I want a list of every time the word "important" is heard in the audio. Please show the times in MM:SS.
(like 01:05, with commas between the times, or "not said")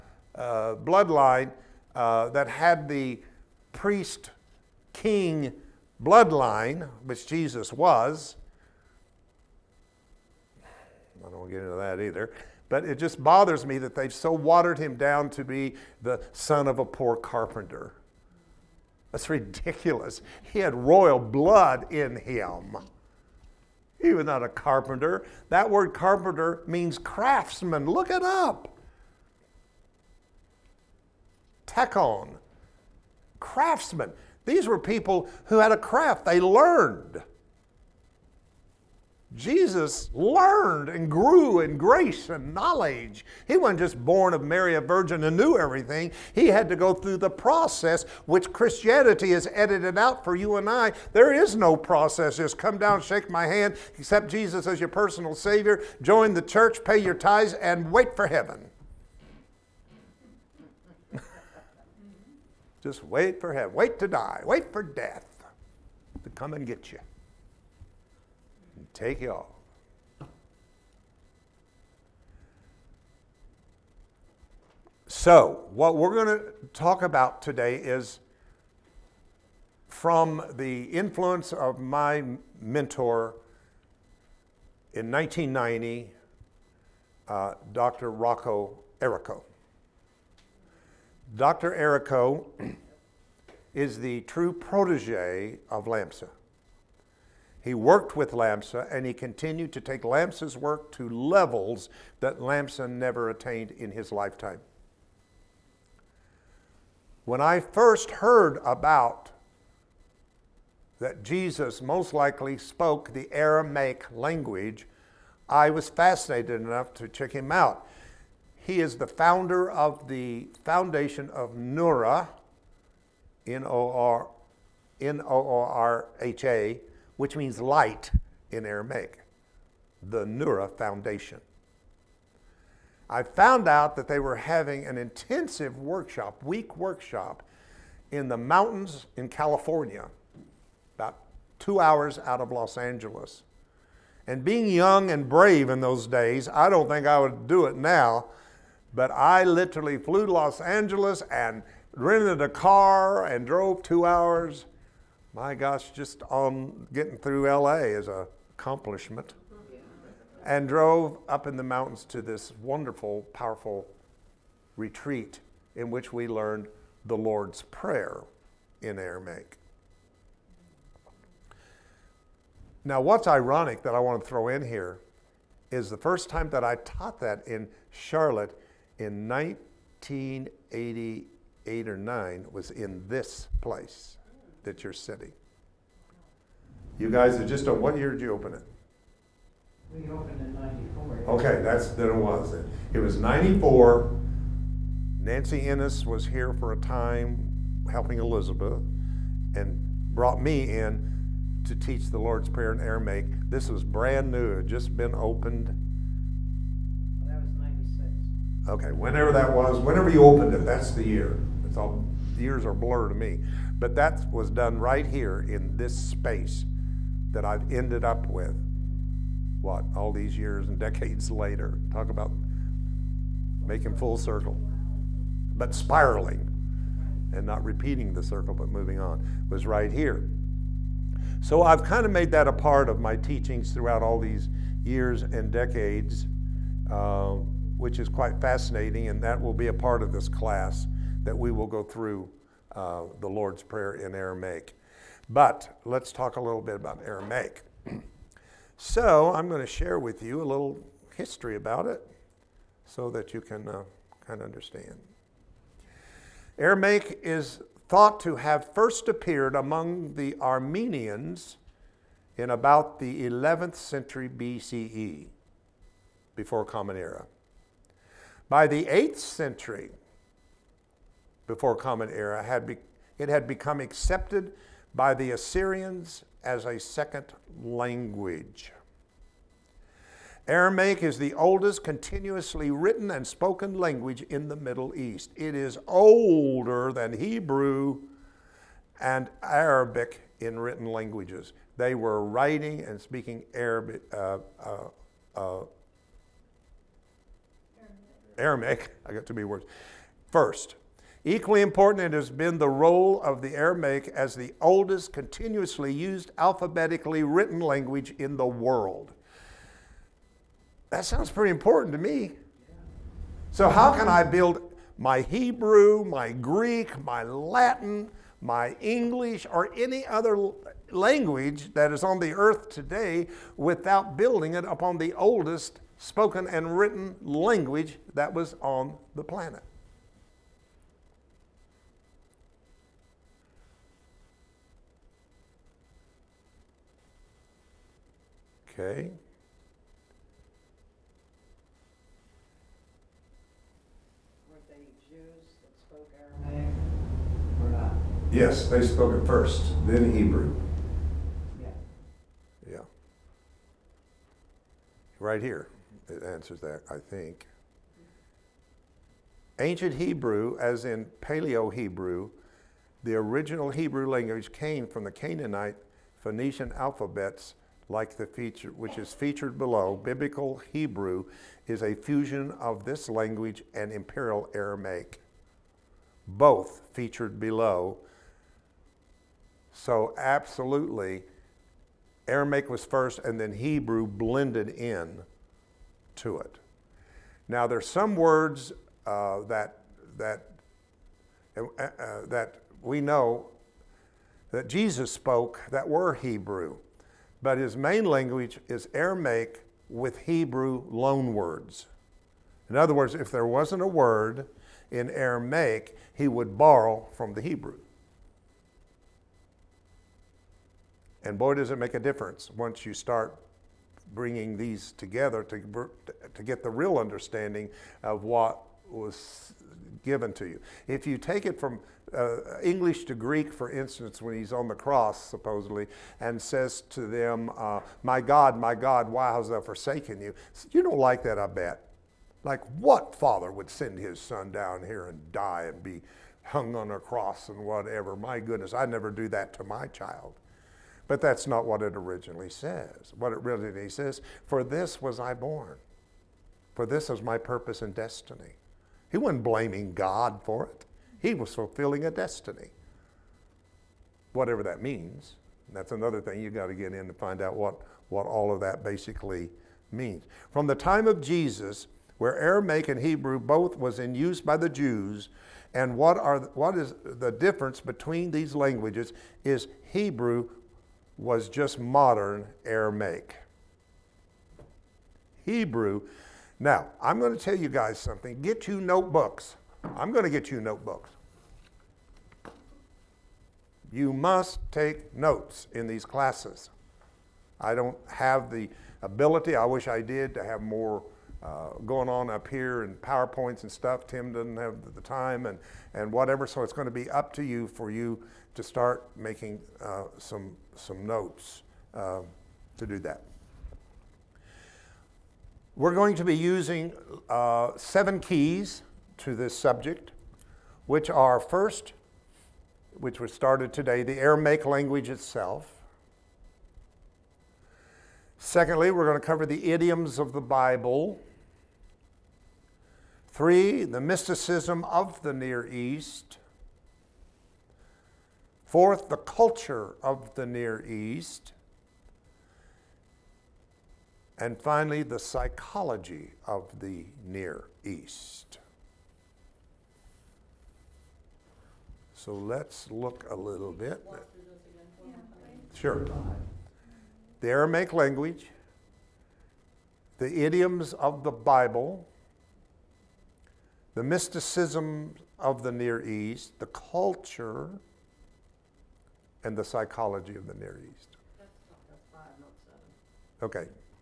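05:01, 05:11.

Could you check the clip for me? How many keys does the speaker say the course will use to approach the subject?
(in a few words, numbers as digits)
7.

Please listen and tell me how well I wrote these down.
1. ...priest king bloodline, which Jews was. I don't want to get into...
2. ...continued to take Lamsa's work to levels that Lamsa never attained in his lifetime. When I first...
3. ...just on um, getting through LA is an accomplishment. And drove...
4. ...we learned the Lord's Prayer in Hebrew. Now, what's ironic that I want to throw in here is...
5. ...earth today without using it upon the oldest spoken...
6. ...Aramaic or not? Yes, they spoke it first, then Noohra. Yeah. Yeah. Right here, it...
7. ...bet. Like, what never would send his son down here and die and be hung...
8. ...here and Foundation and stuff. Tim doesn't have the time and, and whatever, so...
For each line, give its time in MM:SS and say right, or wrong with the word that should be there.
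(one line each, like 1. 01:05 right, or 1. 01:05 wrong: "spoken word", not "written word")
1. 00:03 wrong: "Jesus", not "Jews"
2. 01:39 right
3. 02:35 right
4. 02:46 wrong: "Aramaic", not "Hebrew"
5. 05:22 wrong: "building", not "using"
6. 05:46 wrong: "Hebrew", not "Noohra"
7. 07:11 wrong: "father", not "never"
8. 08:12 wrong: "PowerPoints", not "Foundation".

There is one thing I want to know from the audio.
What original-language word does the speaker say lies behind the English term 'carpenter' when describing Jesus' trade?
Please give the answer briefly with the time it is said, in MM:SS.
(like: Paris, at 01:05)
Tekton, at 00:31.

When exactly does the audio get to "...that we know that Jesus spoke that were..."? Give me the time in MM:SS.
06:32.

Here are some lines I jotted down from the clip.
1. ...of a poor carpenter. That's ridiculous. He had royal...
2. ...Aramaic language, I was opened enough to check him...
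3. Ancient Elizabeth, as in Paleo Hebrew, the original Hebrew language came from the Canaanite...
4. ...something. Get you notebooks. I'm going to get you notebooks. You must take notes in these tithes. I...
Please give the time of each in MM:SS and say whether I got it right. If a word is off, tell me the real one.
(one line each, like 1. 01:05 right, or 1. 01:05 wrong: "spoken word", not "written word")
1. 00:16 right
2. 01:53 wrong: "fascinated", not "opened"
3. 05:59 wrong: "Hebrew", not "Elizabeth"
4. 07:57 wrong: "classes", not "tithes".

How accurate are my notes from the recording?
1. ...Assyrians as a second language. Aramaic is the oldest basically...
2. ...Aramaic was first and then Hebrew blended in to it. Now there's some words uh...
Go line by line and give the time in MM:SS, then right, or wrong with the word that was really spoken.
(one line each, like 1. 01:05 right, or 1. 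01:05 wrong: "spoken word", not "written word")
1. 04:35 wrong: "continuously", not "basically"
2. 06:22 right.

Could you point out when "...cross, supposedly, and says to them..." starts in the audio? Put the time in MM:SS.
07:04.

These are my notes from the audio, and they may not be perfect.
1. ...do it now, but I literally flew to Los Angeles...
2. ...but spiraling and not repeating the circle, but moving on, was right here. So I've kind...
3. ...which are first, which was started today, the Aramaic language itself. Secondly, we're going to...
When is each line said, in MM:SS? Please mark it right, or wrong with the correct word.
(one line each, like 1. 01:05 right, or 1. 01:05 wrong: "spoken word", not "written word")
1. 02:27 right
2. 03:45 right
3. 08:30 right.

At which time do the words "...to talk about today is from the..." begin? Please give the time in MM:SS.
01:16.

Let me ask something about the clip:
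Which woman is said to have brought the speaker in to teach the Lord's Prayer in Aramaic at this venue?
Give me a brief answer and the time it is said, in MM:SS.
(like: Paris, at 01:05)
Nancy Ennis, at 03:15.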